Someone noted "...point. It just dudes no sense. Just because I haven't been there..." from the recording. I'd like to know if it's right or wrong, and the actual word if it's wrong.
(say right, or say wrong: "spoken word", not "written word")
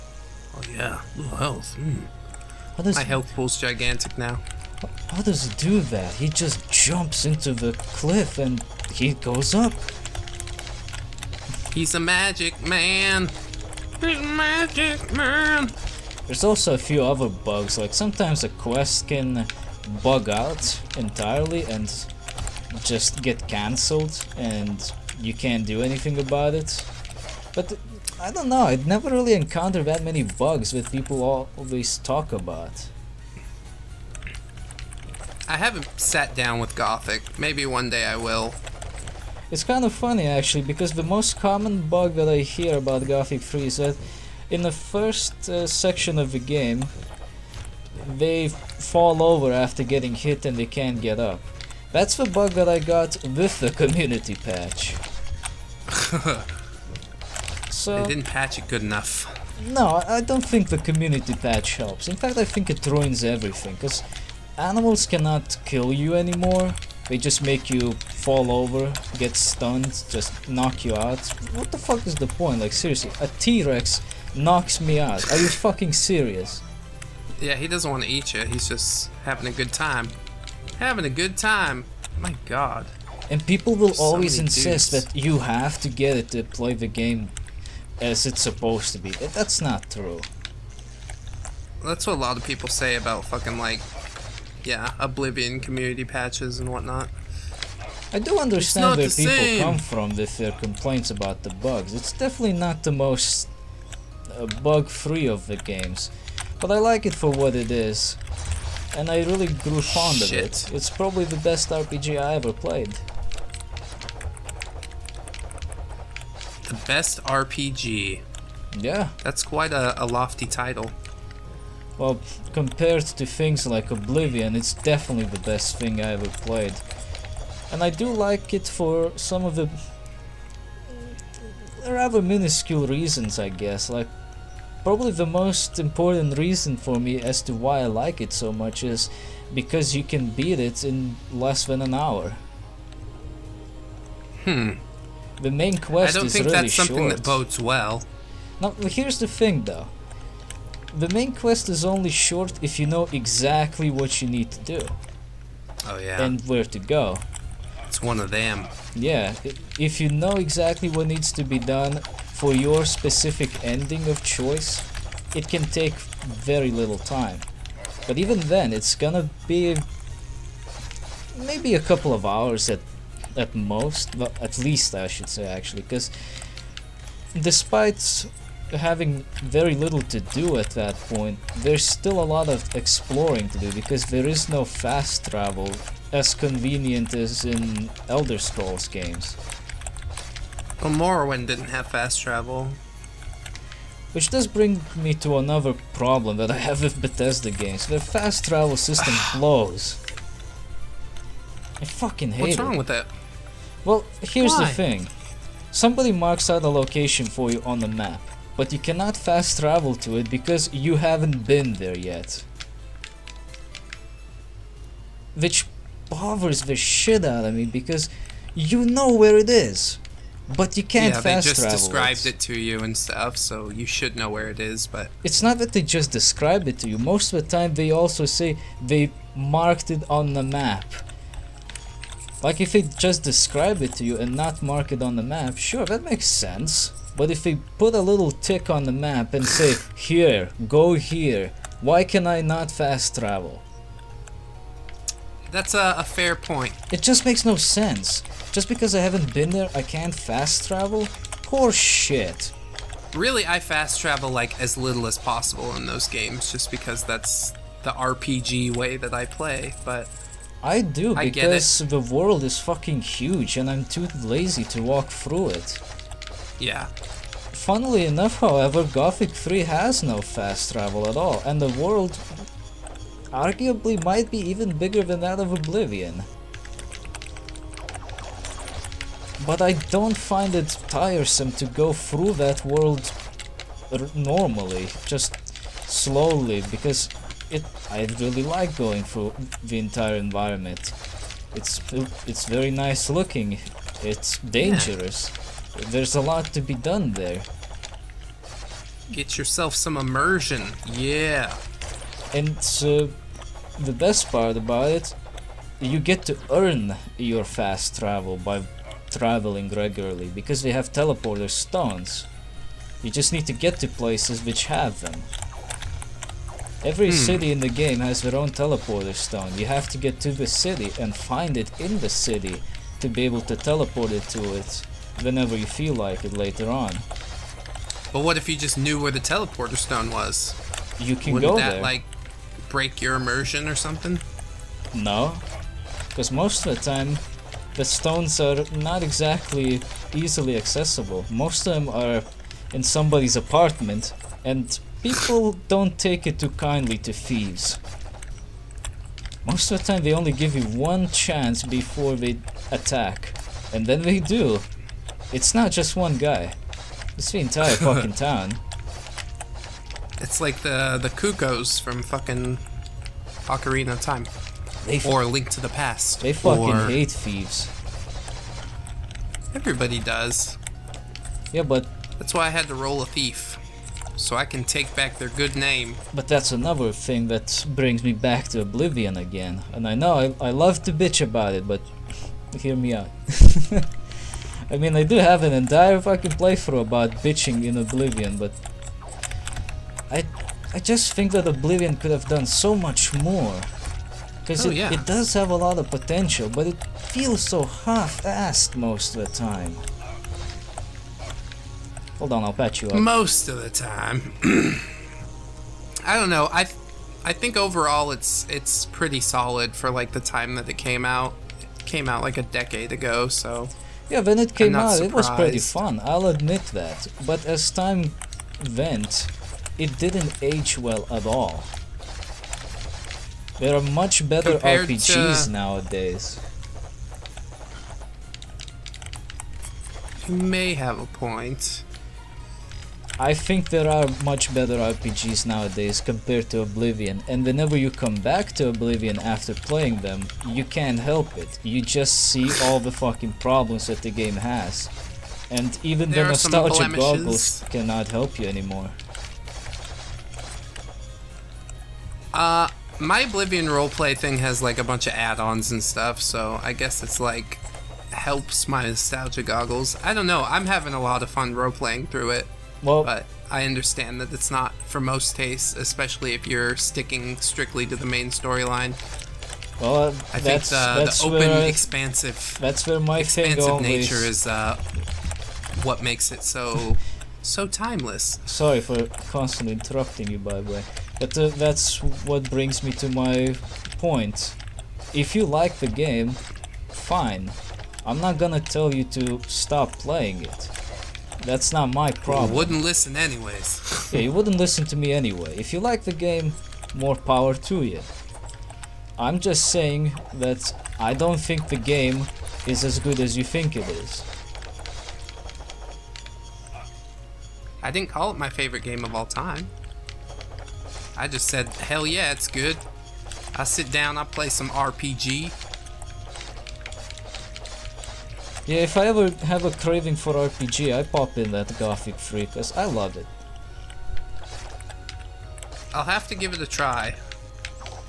wrong: "makes", not "dudes".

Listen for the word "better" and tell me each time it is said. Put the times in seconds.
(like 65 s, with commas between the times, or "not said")
424 s, 434 s.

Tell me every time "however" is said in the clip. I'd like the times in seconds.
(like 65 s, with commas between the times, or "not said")
268 s.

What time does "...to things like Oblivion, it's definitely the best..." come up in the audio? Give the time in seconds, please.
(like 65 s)
123 s.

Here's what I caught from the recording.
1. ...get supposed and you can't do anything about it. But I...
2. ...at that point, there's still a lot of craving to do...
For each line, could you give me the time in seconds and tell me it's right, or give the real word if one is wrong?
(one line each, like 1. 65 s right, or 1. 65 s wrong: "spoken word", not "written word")
1. 23 s wrong: "cancelled", not "supposed"
2. 180 s wrong: "exploring", not "craving".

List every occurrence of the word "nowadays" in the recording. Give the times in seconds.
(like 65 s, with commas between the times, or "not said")
425 s, 435 s.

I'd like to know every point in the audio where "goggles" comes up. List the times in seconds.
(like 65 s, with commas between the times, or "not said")
446 s, 459 s.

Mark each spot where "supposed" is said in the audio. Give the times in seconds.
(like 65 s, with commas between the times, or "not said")
88 s.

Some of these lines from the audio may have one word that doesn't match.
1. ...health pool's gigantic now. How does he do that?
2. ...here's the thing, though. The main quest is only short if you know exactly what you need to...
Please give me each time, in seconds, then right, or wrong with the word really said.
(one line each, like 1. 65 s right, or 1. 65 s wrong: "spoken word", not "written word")
1. 3 s right
2. 148 s right.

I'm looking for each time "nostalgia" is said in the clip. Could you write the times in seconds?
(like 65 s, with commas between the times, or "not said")
446 s, 458 s.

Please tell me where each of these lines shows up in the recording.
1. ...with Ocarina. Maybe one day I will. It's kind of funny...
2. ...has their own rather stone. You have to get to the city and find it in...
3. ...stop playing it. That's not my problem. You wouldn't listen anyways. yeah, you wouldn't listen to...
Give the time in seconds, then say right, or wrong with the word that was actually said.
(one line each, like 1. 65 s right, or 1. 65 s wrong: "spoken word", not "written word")
1. 36 s wrong: "Gothic", not "Ocarina"
2. 317 s wrong: "teleporter", not "rather"
3. 489 s right.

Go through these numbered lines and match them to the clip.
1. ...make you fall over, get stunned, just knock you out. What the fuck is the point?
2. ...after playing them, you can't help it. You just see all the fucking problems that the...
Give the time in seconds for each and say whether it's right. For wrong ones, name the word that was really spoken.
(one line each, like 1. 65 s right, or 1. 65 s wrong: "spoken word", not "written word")
1. 67 s right
2. 439 s right.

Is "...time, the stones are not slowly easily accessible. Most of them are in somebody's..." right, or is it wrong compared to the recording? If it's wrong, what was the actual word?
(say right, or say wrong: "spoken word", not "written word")
wrong: "exactly", not "slowly".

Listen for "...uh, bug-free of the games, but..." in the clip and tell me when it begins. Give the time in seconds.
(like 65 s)
104 s.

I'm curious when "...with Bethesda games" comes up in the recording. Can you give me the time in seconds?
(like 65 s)
196 s.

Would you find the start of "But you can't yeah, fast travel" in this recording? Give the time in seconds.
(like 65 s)
220 s.